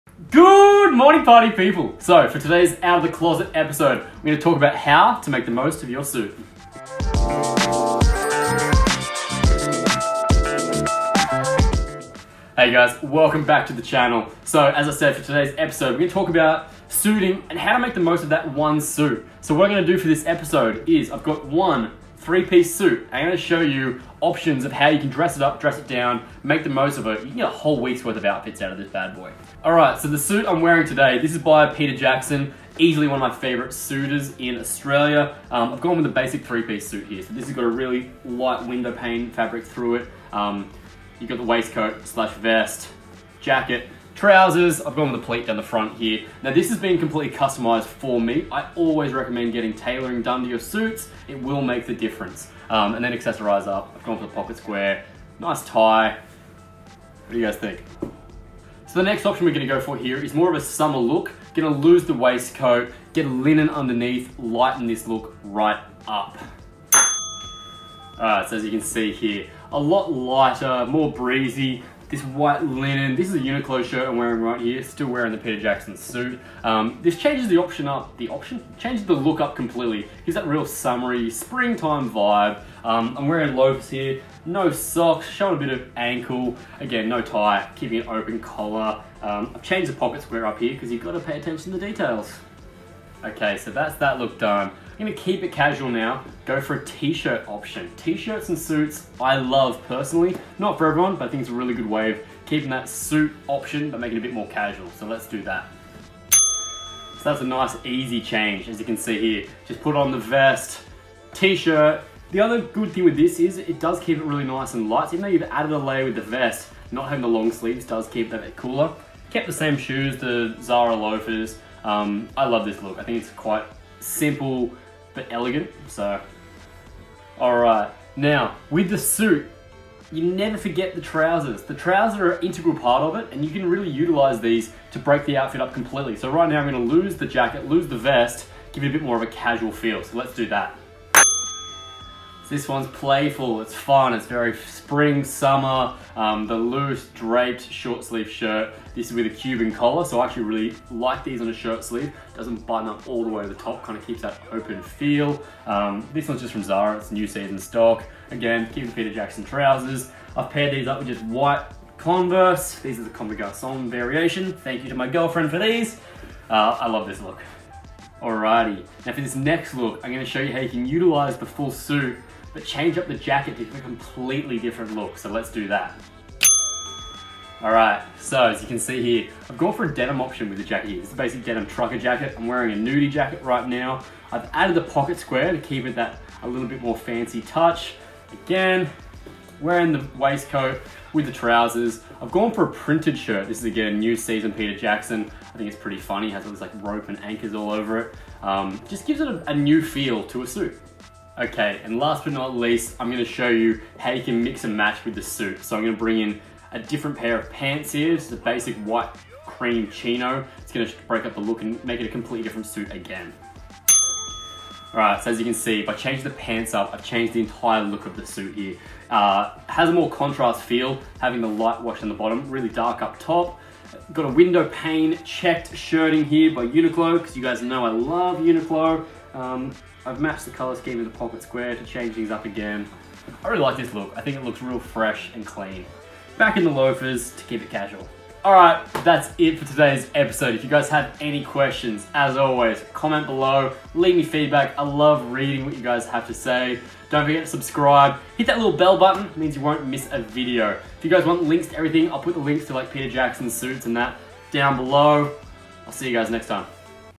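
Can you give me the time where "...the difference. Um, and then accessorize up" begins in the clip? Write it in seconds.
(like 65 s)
51 s.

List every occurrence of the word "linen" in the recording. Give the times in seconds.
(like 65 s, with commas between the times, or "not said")
63 s, 72 s.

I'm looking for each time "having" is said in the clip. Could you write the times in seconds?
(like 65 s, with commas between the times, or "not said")
117 s, 221 s.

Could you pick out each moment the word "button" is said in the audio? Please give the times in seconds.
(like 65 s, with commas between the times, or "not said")
152 s, 248 s.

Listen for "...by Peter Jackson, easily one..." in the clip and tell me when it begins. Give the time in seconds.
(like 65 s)
31 s.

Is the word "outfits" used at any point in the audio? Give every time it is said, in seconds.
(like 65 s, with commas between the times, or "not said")
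28 s, 135 s.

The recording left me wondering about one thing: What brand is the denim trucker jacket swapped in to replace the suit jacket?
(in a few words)
Nudie.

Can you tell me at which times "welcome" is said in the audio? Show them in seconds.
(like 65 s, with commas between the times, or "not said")
13 s.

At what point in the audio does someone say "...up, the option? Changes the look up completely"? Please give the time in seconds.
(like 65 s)
77 s.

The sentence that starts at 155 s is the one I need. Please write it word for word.
Um, this one's just from Zara, it's new season stock.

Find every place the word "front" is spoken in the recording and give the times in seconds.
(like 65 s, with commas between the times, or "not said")
45 s.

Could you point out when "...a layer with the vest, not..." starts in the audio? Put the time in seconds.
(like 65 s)
115 s.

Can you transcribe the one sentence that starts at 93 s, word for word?
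Okay, so that's that look done.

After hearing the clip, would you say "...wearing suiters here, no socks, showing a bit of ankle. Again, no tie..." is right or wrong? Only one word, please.
wrong.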